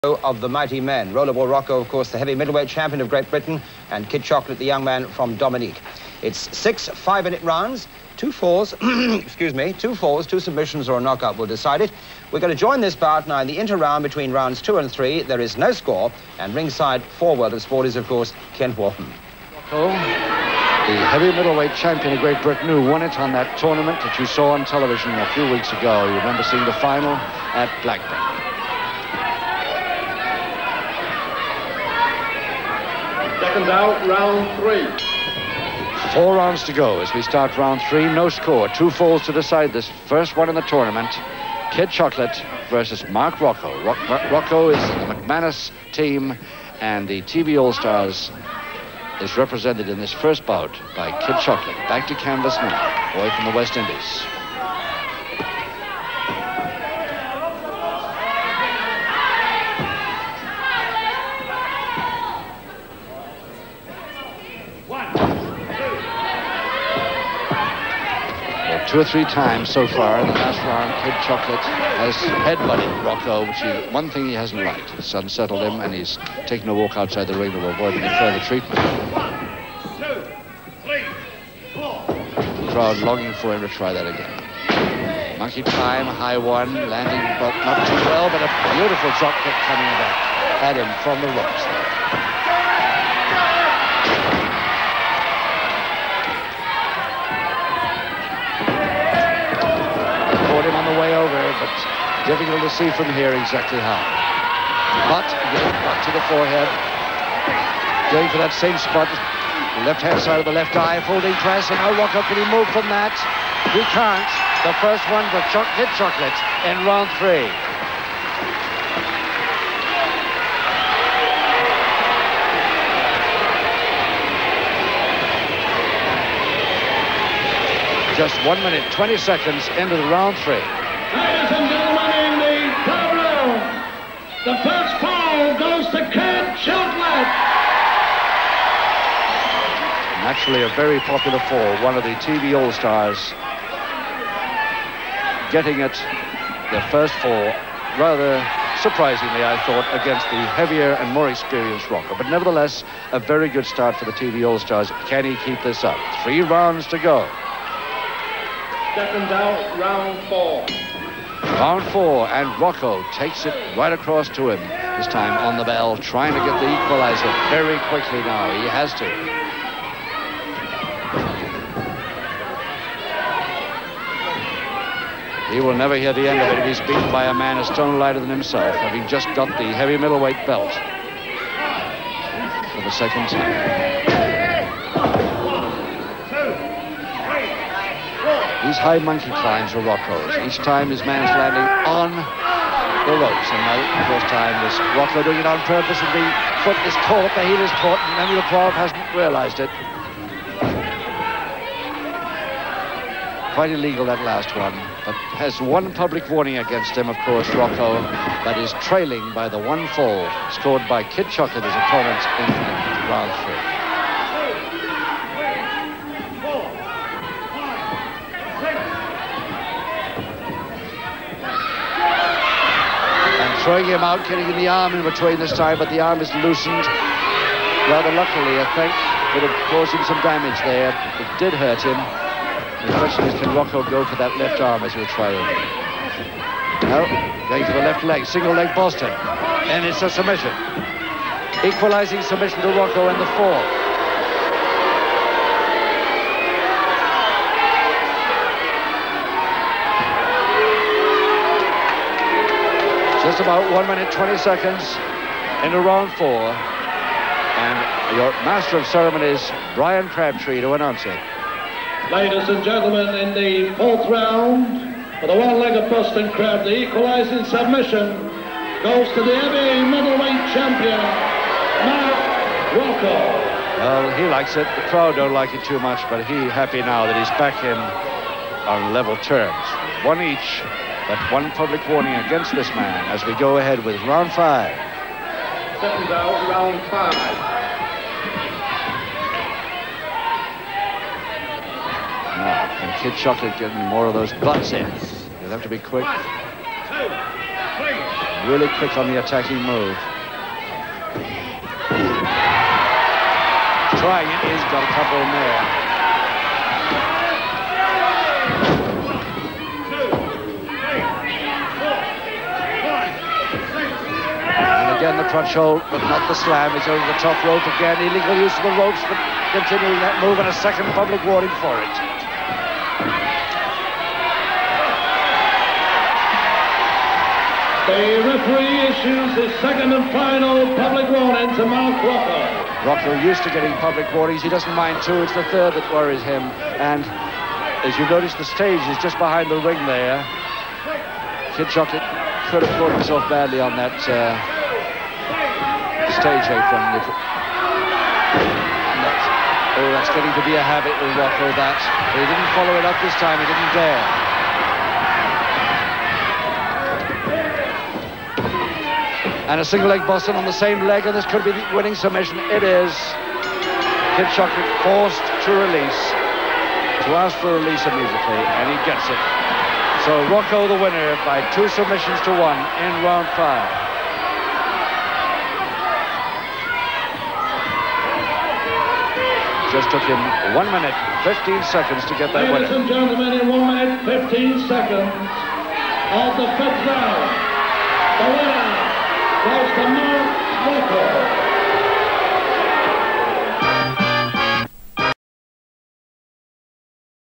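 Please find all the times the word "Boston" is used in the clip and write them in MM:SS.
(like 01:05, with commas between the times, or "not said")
03:58, 04:25, 06:00.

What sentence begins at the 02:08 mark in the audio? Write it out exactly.
just one minute, 20 seconds into the round three.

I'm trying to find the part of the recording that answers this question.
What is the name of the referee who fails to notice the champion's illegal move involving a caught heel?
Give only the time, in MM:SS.
03:18.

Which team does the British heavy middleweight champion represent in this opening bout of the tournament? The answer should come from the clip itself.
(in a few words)
McManus team.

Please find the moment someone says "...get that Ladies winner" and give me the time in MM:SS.
06:22.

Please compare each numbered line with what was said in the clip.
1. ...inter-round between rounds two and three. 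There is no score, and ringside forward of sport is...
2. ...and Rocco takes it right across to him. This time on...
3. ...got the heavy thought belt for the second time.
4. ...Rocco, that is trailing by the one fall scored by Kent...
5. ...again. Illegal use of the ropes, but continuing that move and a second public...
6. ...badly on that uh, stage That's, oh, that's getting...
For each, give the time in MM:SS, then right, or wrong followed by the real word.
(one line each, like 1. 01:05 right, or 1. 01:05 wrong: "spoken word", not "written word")
1. 00:13 right
2. 02:42 right
3. 02:59 wrong: "middleweight", not "thought"
4. 03:27 wrong: "Kid", not "Kent"
5. 05:17 right
6. 05:43 right.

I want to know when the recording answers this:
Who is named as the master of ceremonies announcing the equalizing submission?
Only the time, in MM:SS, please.
04:19.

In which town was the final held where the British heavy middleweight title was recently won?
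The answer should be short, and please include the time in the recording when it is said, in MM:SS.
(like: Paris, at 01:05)
Blackburn, at 00:27.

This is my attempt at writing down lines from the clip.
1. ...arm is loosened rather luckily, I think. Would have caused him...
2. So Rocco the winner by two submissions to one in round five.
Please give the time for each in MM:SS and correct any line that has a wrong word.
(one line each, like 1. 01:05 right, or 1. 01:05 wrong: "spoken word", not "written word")
1. 03:45 right
2. 06:10 right.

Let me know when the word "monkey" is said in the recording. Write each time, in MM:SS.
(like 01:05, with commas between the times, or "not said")
01:25, 03:08.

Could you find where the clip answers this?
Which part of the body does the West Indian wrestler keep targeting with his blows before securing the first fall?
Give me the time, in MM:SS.
01:46.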